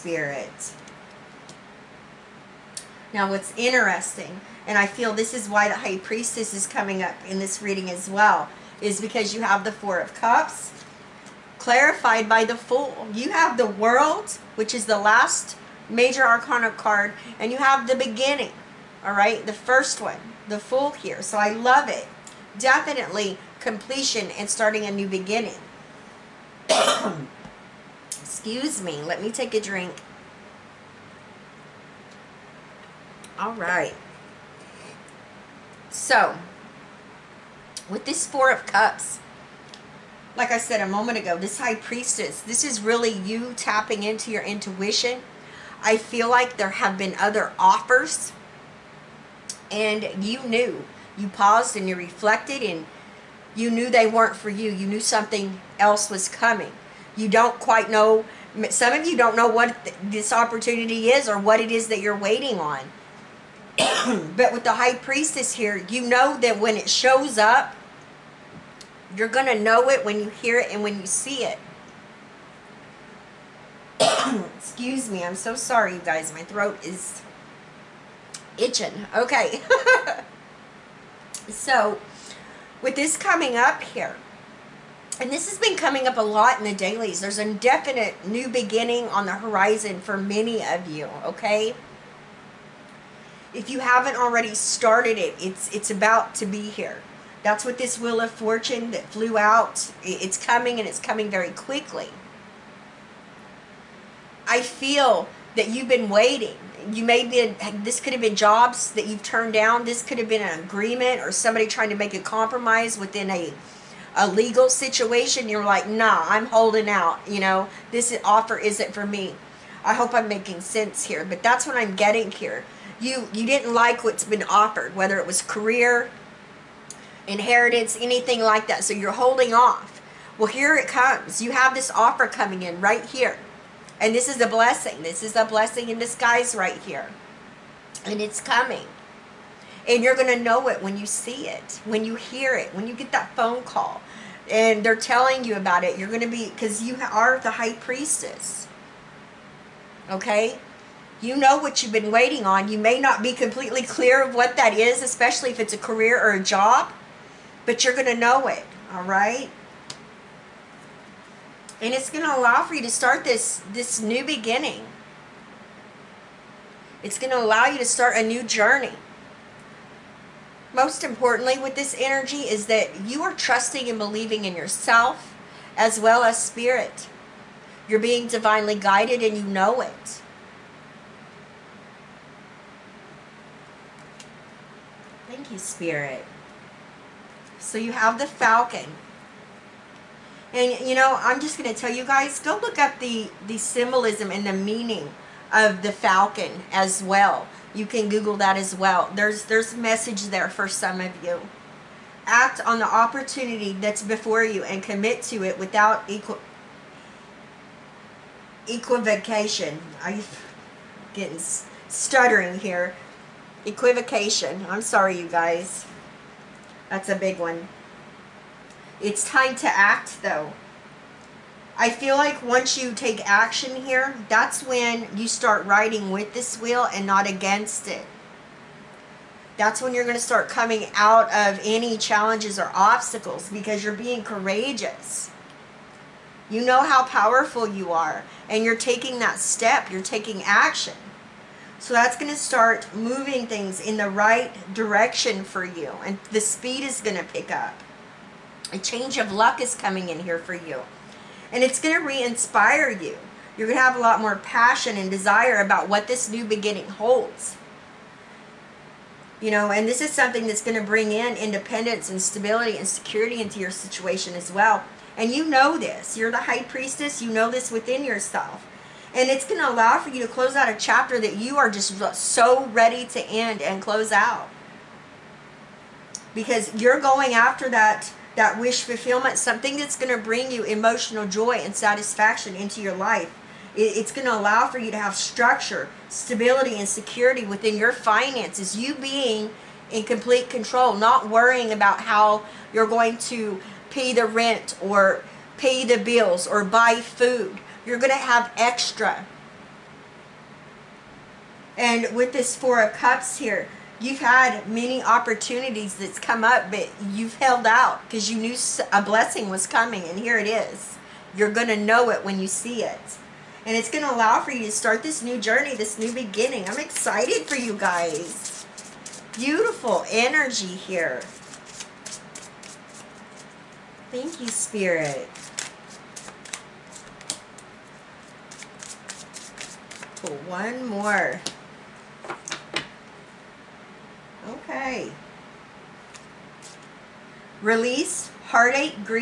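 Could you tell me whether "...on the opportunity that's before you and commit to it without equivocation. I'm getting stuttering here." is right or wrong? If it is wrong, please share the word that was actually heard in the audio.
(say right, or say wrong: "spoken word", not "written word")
right.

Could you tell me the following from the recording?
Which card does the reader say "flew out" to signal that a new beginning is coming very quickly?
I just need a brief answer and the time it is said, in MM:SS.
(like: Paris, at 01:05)
Wheel of Fortune, at 01:37.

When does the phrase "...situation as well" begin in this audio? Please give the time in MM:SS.
04:23.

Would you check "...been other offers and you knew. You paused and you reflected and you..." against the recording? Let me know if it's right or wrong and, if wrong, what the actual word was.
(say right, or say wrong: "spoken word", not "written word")
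right.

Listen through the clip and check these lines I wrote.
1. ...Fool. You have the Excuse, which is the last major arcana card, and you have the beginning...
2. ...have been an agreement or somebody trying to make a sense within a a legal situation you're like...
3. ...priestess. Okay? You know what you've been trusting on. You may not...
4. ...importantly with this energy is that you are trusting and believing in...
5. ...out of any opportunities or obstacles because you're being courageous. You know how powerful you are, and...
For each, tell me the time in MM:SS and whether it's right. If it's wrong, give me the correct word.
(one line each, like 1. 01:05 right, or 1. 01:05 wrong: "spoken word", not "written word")
1. 00:12 wrong: "World", not "Excuse"
2. 01:50 wrong: "compromise", not "sense"
3. 02:27 wrong: "waiting", not "trusting"
4. 02:51 right
5. 03:50 wrong: "challenges", not "opportunities".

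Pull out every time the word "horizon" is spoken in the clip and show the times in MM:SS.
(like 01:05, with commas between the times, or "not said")
01:29.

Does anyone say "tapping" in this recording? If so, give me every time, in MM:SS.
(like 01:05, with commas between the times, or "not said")
00:43.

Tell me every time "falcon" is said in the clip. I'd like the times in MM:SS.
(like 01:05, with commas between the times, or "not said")
03:08, 03:15.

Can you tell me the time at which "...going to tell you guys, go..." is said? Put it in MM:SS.
03:11.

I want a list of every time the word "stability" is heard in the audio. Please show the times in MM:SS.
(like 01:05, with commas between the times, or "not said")
04:22, 04:46.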